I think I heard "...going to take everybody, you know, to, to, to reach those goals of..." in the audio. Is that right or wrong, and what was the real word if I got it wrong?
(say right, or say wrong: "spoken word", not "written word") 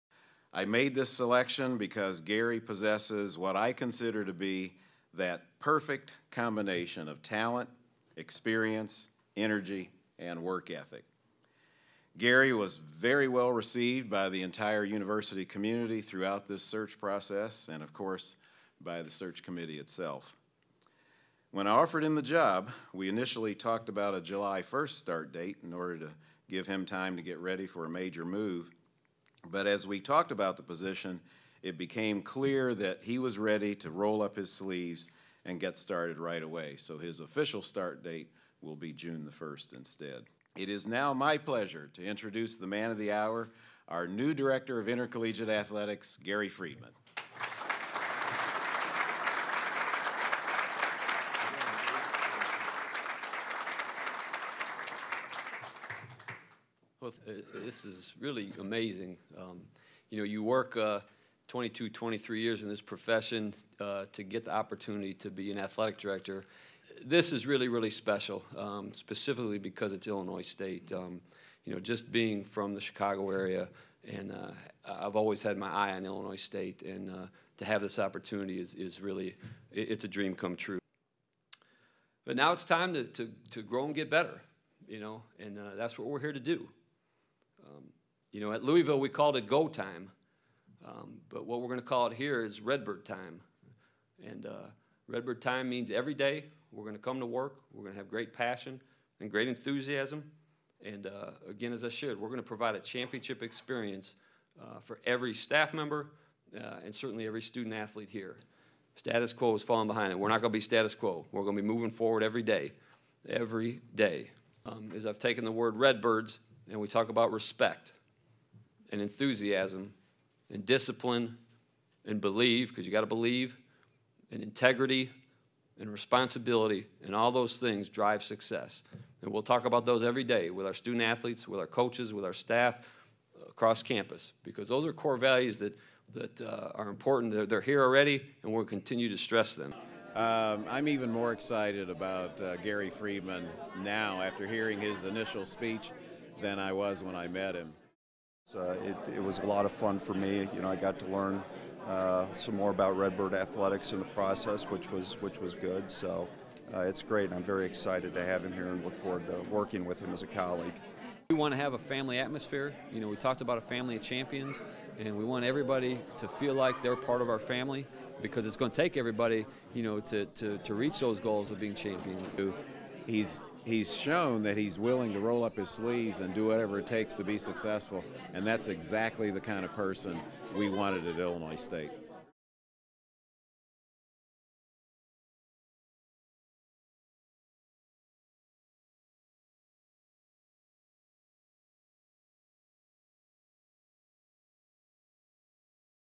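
right.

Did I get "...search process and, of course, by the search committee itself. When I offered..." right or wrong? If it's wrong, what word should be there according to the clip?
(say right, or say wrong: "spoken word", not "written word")
right.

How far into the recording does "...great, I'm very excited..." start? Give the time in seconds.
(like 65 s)
157 s.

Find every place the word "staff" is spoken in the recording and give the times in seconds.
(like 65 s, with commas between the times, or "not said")
105 s, 132 s.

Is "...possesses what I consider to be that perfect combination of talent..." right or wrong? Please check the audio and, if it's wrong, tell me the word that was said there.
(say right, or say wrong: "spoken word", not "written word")
right.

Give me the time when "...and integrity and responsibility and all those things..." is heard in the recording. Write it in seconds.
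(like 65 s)
124 s.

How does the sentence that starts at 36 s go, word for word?
So his official start date will be June the 1st instead.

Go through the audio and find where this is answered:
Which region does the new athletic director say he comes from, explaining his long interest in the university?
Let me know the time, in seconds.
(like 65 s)
72 s.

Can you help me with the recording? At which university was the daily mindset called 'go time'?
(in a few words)
Louisville.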